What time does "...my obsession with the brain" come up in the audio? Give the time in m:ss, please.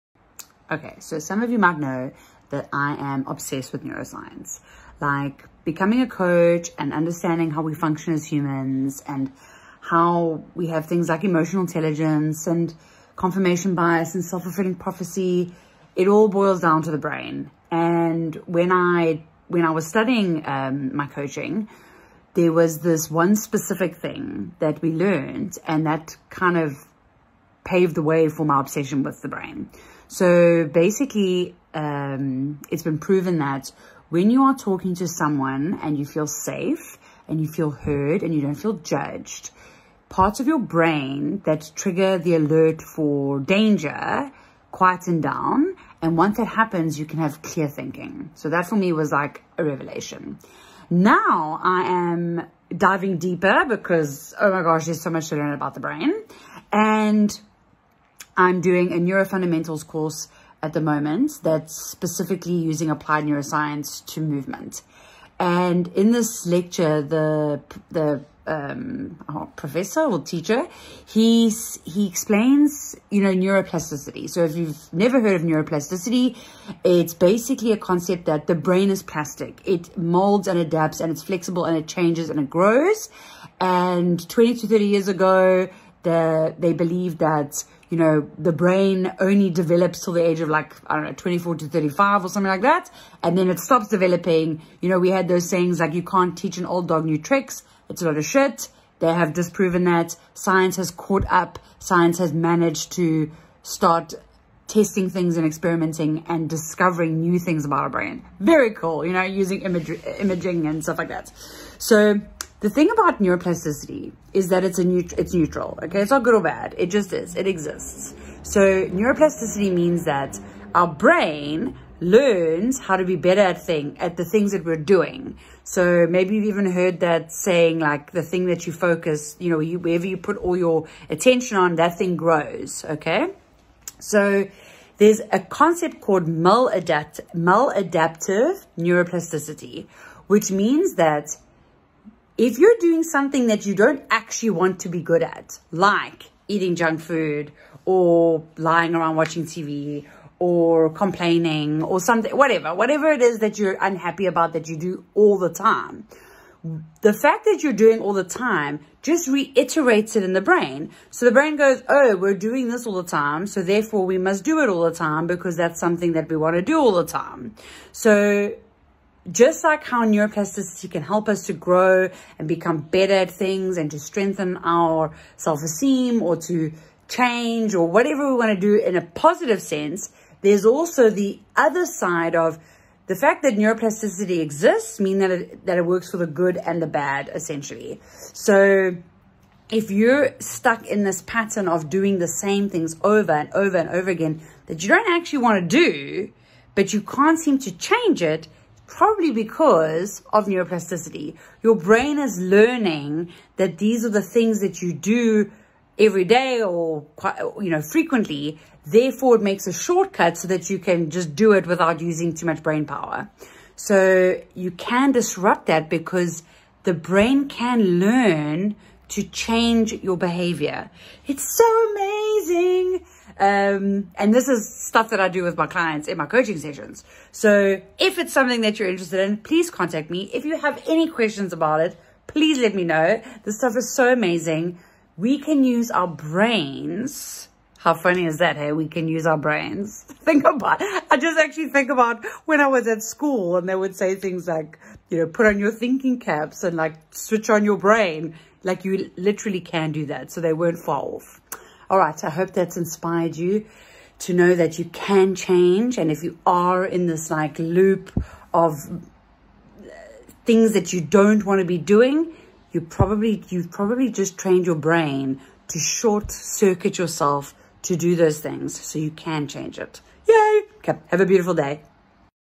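0:28.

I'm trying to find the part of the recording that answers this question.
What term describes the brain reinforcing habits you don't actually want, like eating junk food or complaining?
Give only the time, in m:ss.
2:17.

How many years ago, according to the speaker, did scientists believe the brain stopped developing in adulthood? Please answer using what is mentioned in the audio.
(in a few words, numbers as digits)
20 to 30.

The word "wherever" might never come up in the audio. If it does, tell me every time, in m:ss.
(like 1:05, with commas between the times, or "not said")
2:09.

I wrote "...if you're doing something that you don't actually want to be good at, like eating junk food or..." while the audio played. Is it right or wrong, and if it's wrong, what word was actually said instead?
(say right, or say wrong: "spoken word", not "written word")
right.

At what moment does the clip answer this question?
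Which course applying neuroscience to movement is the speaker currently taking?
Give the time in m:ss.
0:58.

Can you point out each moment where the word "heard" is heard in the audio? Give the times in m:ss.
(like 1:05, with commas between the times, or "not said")
0:37, 1:15, 2:06.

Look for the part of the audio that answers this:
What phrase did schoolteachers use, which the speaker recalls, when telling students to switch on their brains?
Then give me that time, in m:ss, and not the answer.
4:05.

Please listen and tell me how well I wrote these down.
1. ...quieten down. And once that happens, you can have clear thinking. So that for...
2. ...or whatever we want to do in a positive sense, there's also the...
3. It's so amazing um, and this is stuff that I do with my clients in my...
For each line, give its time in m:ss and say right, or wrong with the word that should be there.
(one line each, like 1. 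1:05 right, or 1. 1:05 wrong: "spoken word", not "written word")
1. 0:44 right
2. 2:57 right
3. 3:41 right.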